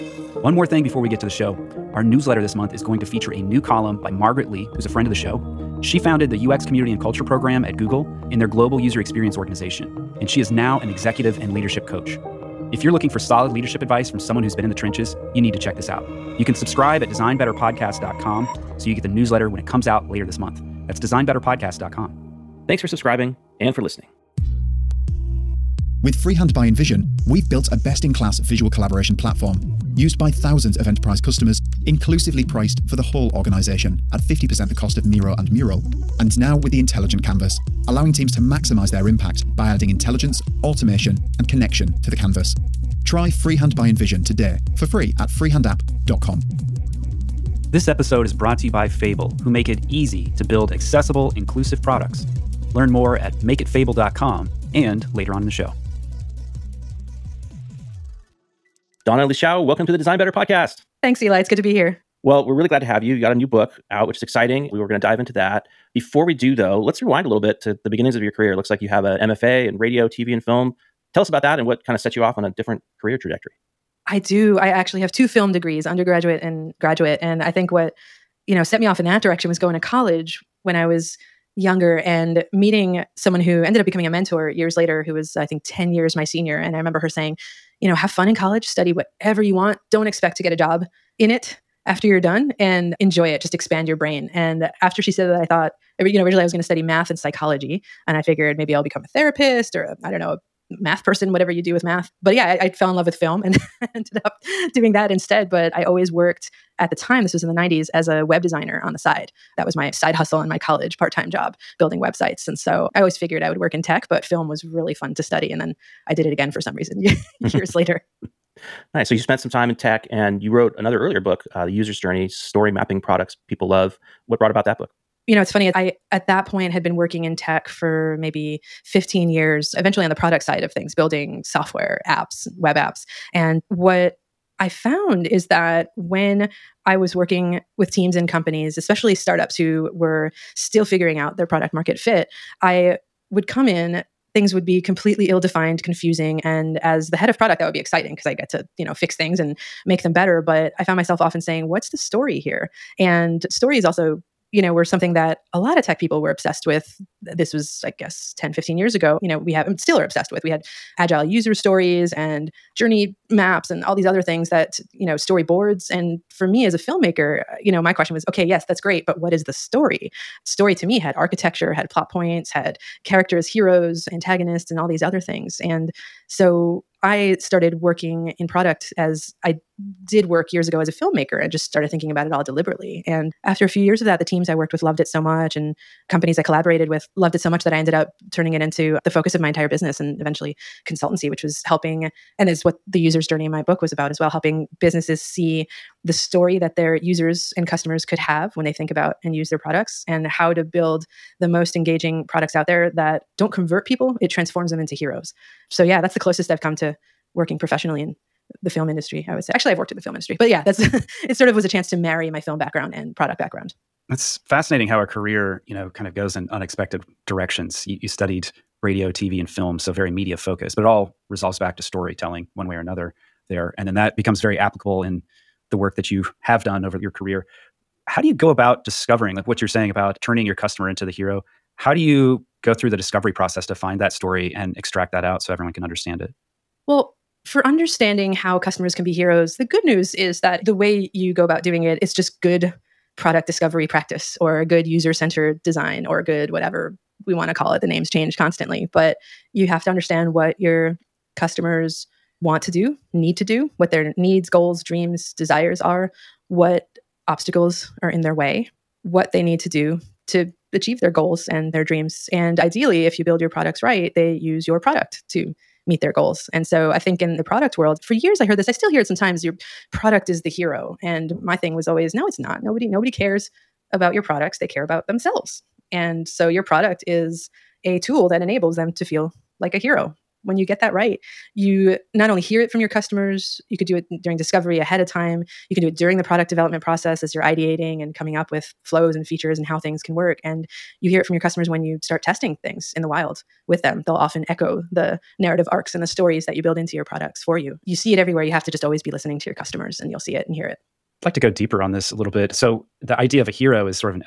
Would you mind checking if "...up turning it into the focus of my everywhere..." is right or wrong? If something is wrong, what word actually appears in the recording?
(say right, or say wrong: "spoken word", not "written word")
wrong: "entire", not "everywhere".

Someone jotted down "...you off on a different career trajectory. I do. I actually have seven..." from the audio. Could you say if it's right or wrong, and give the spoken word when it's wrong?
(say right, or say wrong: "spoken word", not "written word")
wrong: "two", not "seven".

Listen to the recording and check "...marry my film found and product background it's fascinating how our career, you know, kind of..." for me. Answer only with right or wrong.
wrong.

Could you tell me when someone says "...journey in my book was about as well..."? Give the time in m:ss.
3:13.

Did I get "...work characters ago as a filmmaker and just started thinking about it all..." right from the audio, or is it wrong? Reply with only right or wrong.
wrong.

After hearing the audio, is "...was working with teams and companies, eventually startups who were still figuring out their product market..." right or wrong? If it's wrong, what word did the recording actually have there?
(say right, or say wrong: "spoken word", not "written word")
wrong: "especially", not "eventually".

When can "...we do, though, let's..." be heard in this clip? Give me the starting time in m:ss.
1:06.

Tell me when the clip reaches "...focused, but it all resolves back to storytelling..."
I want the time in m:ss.
3:40.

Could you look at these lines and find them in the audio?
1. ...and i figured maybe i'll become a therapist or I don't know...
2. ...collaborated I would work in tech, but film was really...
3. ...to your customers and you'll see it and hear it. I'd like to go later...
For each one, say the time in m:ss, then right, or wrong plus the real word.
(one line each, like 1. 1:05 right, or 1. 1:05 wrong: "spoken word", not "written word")
1. 1:38 right
2. 1:53 wrong: "figured", not "collaborated"
3. 4:59 wrong: "deeper", not "later".